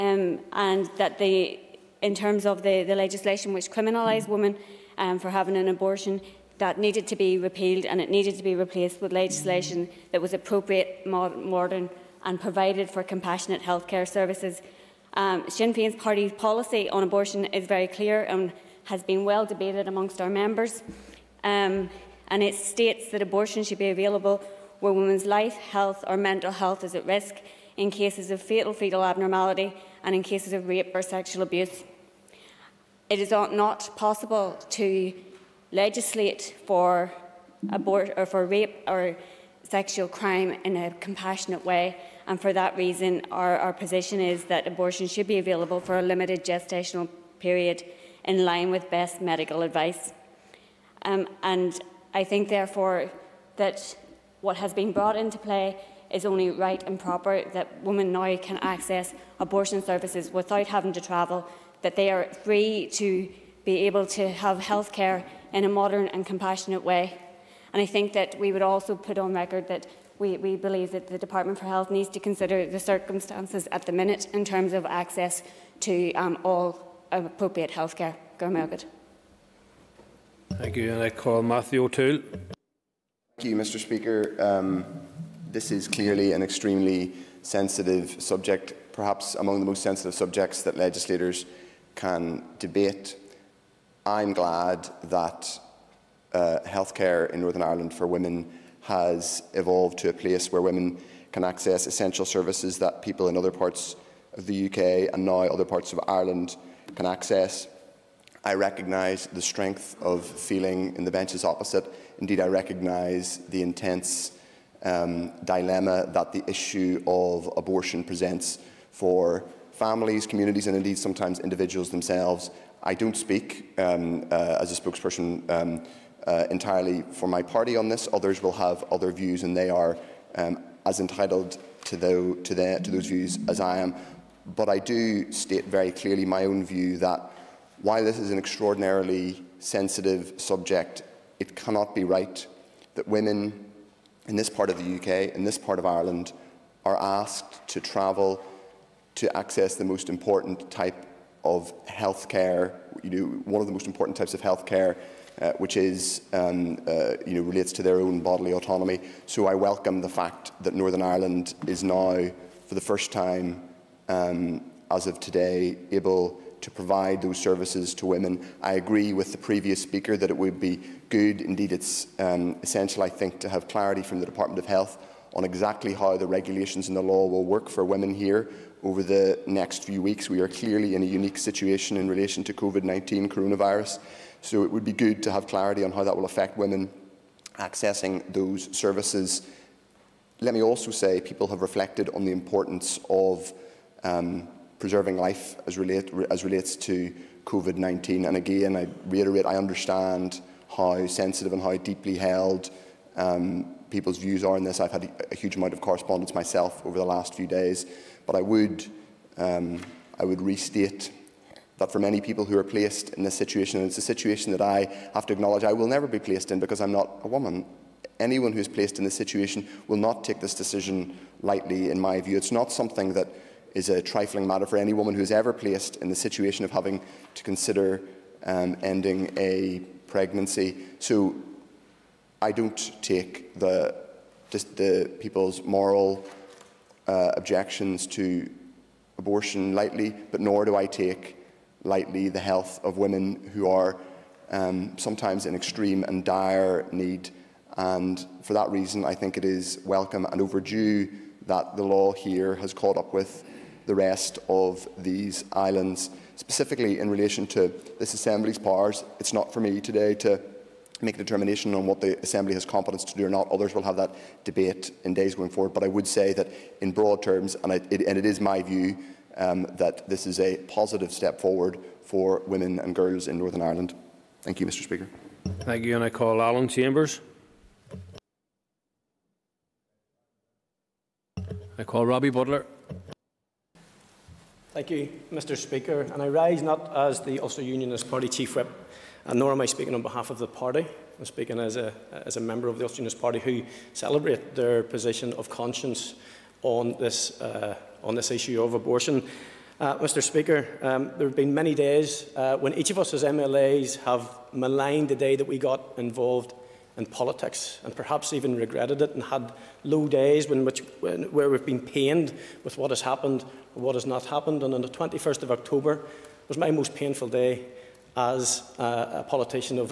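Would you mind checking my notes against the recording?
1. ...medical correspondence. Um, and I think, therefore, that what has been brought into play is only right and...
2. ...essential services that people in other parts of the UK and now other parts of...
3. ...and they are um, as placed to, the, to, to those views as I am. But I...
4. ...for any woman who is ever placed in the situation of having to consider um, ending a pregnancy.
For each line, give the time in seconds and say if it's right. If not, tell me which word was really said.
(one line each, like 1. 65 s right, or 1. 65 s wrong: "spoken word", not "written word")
1. 49 s wrong: "advice", not "correspondence"
2. 101 s right
3. 129 s wrong: "entitled", not "placed"
4. 224 s right.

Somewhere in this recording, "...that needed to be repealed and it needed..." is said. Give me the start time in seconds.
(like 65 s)
6 s.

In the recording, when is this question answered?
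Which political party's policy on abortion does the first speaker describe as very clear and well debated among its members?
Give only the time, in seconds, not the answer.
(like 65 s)
15 s.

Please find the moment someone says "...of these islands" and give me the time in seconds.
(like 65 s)
254 s.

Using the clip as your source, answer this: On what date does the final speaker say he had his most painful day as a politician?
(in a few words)
21 October.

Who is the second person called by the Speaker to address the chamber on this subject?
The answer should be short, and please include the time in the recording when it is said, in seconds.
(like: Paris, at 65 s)
Matthew O'Toole, at 81 s.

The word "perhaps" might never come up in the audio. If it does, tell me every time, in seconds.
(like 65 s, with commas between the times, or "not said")
88 s, 307 s.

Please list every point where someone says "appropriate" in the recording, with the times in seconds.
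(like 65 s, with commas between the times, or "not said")
10 s, 77 s.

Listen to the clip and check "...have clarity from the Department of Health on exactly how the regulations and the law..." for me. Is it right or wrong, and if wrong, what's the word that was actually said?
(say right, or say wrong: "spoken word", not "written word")
right.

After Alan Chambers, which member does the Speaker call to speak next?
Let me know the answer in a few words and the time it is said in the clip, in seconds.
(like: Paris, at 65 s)
Robbie Butler, at 282 s.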